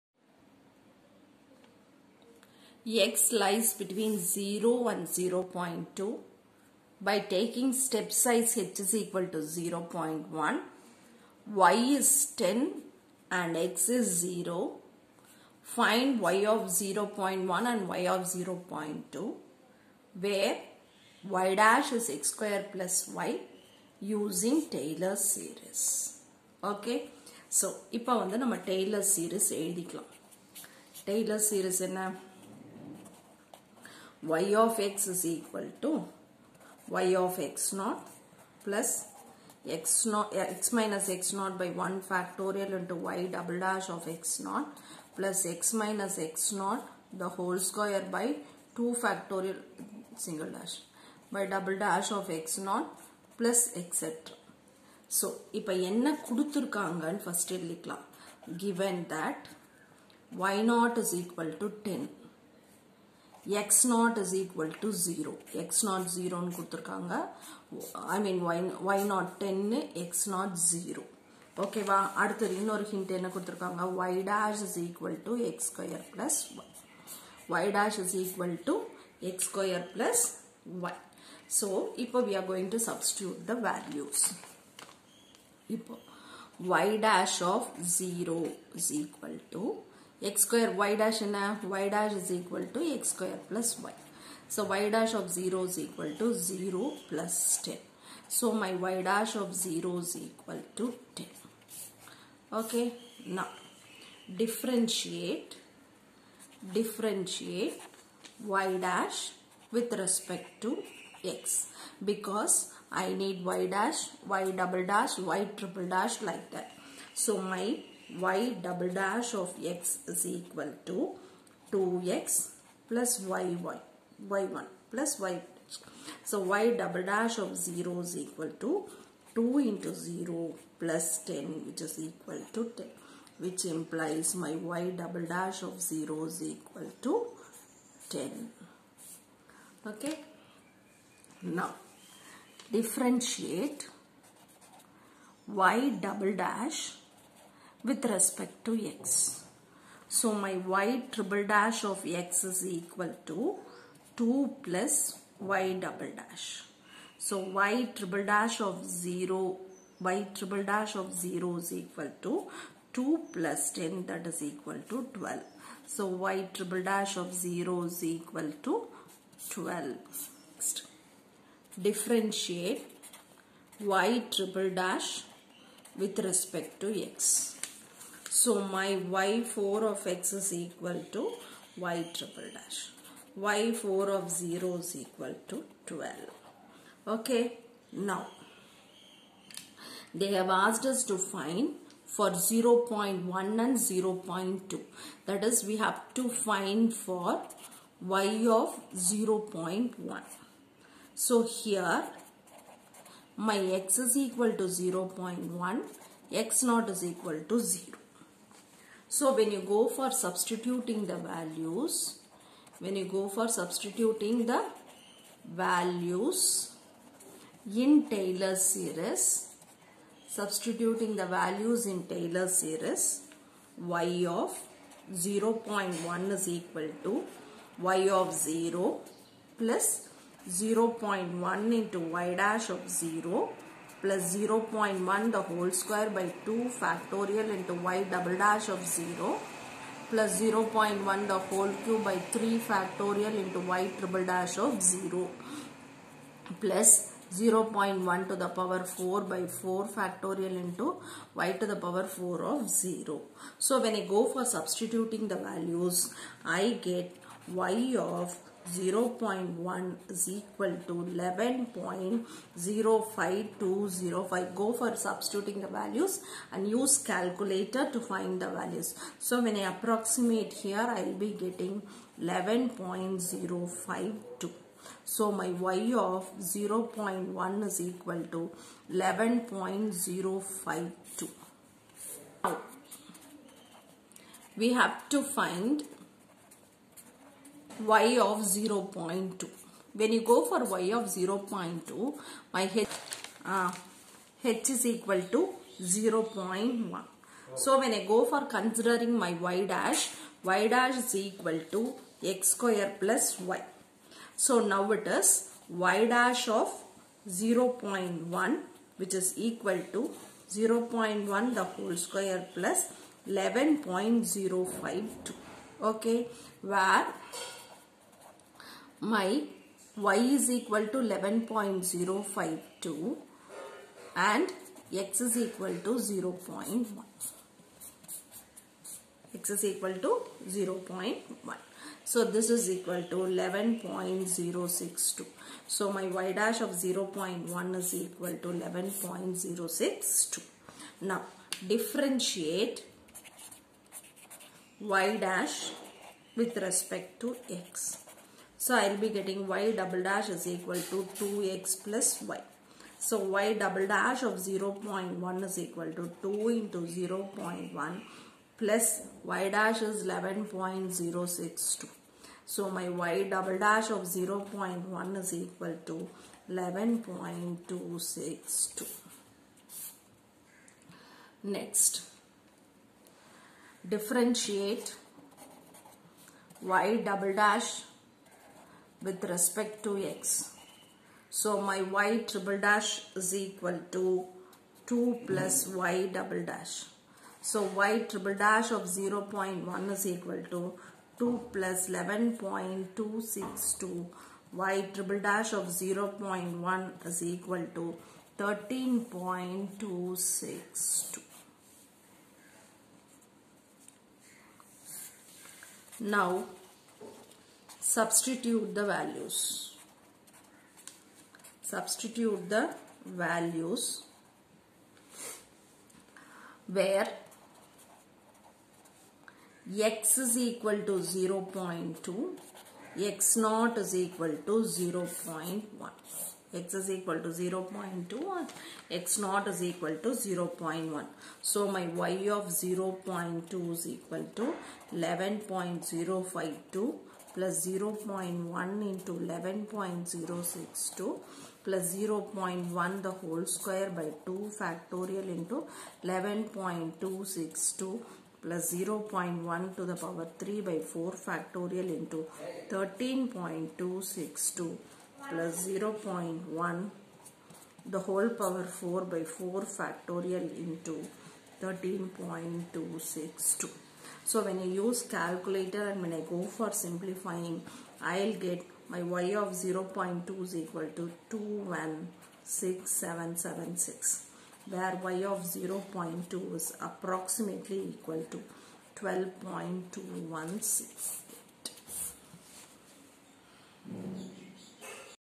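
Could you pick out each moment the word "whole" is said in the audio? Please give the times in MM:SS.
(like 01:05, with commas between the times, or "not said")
00:47, 03:55, 04:01, 05:11, 07:23, 07:38.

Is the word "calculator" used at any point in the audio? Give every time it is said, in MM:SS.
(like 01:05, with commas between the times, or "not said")
04:26, 07:45.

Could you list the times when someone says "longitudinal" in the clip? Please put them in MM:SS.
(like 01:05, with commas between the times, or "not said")
not said.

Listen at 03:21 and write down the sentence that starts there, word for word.
So, here my x is equal to 0 0.1, x naught is equal to 0.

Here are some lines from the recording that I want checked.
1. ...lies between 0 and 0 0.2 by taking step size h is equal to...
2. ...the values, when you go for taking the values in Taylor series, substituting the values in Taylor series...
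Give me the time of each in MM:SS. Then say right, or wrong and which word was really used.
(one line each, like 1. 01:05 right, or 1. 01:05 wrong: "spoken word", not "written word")
1. 00:03 right
2. 03:31 wrong: "substituting", not "taking".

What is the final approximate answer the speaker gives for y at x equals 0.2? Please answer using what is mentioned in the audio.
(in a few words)
12.216.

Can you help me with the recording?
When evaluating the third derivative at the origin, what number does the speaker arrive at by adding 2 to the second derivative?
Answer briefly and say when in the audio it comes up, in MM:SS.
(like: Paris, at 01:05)
12, at 02:44.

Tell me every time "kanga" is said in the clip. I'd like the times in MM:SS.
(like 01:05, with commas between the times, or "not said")
01:06, 01:13.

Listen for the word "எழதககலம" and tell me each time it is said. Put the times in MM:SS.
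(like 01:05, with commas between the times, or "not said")
00:29, 00:57.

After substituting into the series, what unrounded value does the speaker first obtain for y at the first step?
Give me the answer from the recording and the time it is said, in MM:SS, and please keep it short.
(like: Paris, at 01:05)
11.05205, at 04:20.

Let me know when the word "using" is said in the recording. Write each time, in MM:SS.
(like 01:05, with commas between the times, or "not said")
00:23.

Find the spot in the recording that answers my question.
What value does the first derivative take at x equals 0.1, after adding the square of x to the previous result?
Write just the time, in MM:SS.
05:32.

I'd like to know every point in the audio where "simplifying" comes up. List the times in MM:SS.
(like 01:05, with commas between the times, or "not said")
07:46.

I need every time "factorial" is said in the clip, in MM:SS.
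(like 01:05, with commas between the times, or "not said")
00:42, 00:49, 03:56, 04:02, 04:09, 07:24, 07:31, 07:39.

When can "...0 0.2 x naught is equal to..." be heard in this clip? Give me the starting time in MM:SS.
07:01.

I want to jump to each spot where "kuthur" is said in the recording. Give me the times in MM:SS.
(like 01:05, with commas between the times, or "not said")
01:06, 01:13.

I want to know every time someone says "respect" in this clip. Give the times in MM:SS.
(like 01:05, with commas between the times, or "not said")
01:49, 02:28, 02:56, 05:46, 06:19.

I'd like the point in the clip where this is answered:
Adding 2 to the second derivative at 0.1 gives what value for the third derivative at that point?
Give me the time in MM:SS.
06:37.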